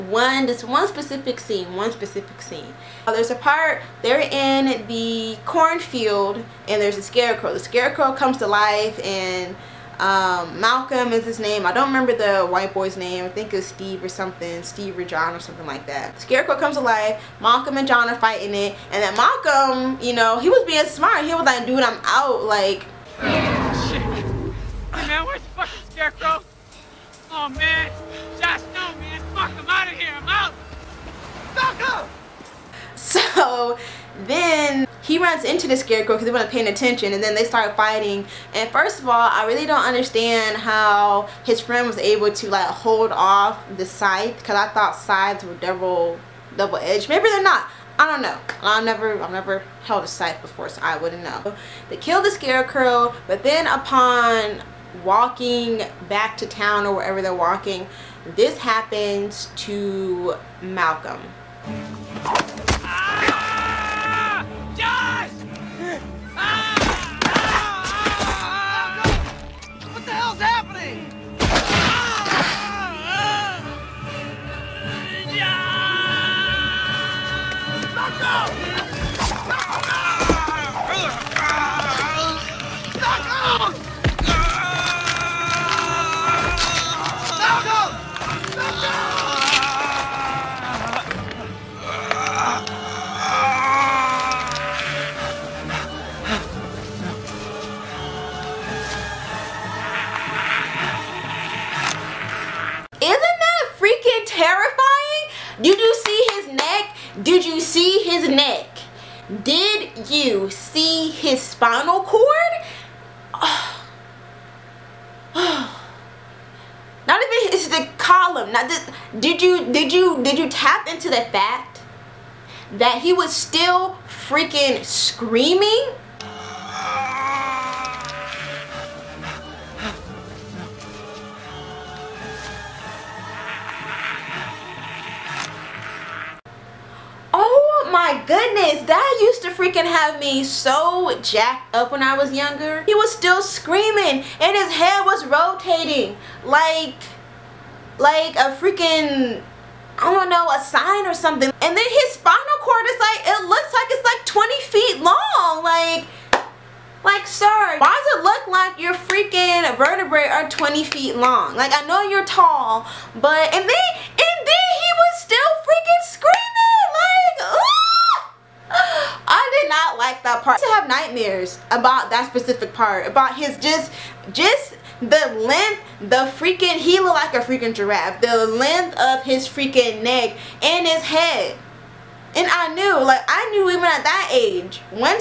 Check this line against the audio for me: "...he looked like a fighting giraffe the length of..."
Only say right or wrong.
wrong.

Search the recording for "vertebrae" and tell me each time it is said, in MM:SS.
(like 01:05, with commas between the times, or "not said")
02:39.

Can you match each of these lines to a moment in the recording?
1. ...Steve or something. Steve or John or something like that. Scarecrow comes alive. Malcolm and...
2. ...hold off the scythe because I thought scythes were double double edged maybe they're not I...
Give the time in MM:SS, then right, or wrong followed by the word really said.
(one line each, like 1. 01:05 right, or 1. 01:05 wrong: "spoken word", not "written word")
1. 00:13 right
2. 00:42 right.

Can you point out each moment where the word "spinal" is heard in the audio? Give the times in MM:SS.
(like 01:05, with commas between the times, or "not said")
01:51, 02:32.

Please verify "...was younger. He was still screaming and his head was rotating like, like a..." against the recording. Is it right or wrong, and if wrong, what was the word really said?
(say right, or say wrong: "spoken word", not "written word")
right.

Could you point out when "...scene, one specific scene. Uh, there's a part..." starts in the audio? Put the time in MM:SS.
00:01.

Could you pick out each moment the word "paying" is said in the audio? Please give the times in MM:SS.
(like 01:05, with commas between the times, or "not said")
00:36.